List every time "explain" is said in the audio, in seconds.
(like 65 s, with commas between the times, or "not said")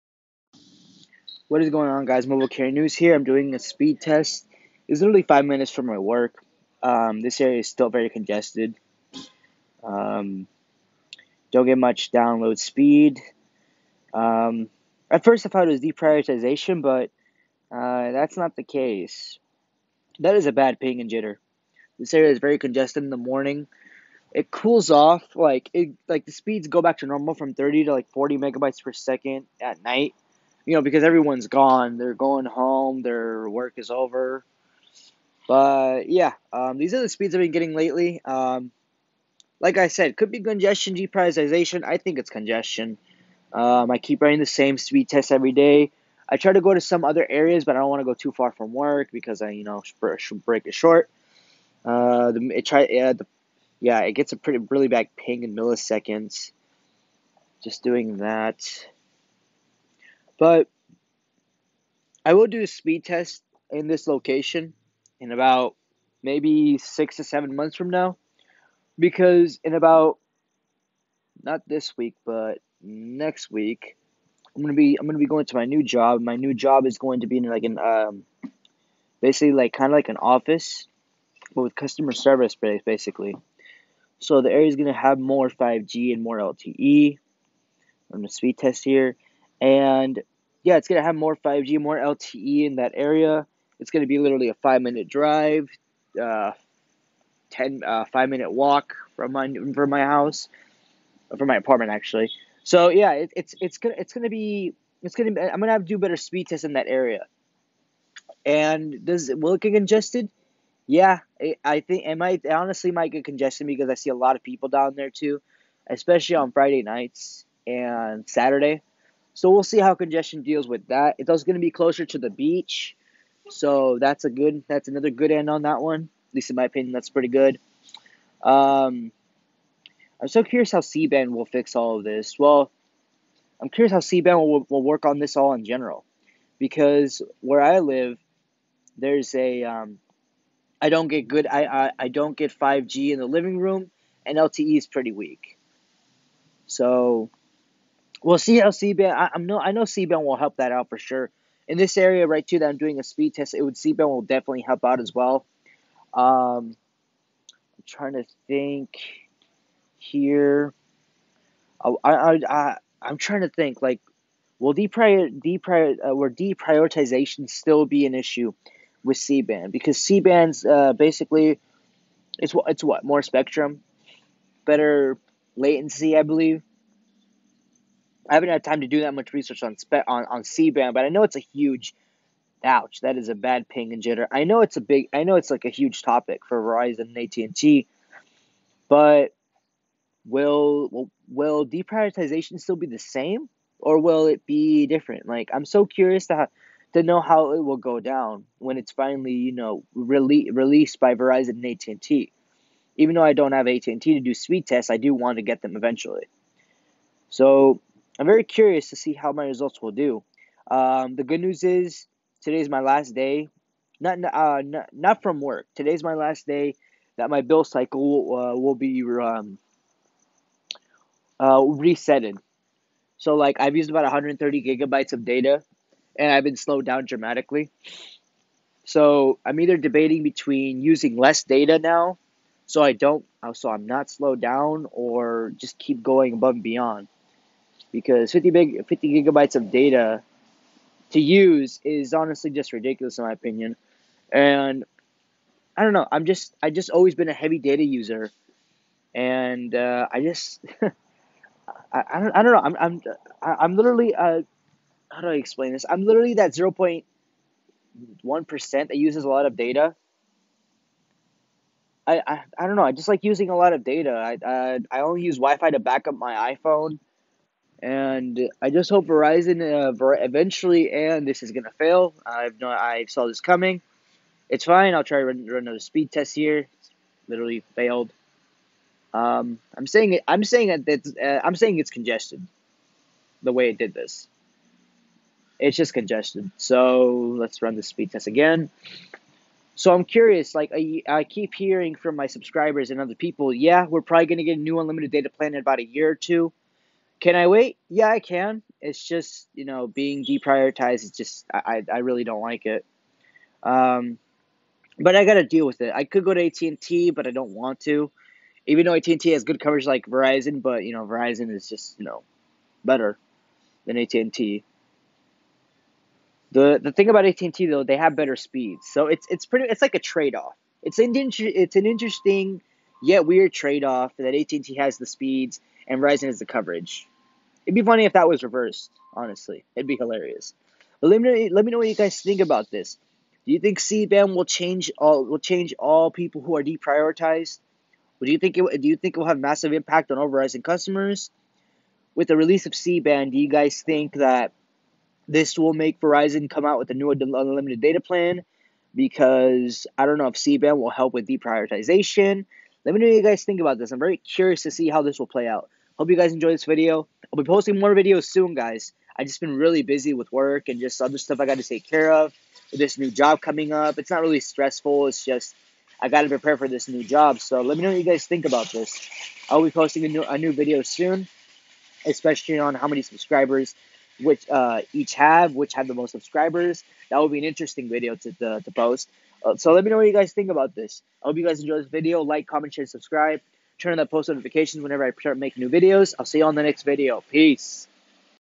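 255 s.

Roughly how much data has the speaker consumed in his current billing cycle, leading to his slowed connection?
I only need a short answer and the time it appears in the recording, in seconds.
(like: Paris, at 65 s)
130 gigabytes, at 224 s.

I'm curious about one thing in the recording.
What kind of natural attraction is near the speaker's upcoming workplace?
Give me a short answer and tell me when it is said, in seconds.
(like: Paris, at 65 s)
the beach, at 122 s.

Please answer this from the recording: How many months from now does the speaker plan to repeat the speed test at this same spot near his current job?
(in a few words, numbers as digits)
6 to 7.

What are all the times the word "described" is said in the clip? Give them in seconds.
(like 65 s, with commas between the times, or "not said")
not said.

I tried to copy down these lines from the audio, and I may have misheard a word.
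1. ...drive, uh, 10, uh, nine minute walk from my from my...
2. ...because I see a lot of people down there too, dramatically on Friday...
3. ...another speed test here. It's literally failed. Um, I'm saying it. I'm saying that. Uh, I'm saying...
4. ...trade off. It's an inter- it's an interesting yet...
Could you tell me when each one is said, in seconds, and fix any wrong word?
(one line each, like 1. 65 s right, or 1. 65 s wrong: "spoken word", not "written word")
1. 95 s wrong: "five", not "nine"
2. 113 s wrong: "especially", not "dramatically"
3. 275 s right
4. 319 s right.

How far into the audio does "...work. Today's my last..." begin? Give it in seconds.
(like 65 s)
215 s.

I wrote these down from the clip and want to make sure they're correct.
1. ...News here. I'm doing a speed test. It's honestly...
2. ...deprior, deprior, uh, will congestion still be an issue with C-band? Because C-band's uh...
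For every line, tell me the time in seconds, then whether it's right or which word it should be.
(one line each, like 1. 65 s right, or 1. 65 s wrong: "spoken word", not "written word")
1. 2 s wrong: "literally", not "honestly"
2. 164 s wrong: "deprioritization", not "congestion".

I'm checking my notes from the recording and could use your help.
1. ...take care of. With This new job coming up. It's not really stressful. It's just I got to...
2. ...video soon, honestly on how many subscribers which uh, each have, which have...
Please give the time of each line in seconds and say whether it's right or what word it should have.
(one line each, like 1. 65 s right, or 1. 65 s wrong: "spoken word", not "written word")
1. 361 s right
2. 370 s wrong: "especially", not "honestly".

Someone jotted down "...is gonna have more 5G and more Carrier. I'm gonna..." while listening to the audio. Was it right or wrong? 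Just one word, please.
wrong.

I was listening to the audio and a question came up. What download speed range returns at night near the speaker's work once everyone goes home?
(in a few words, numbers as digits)
30 to 40 megabytes per second.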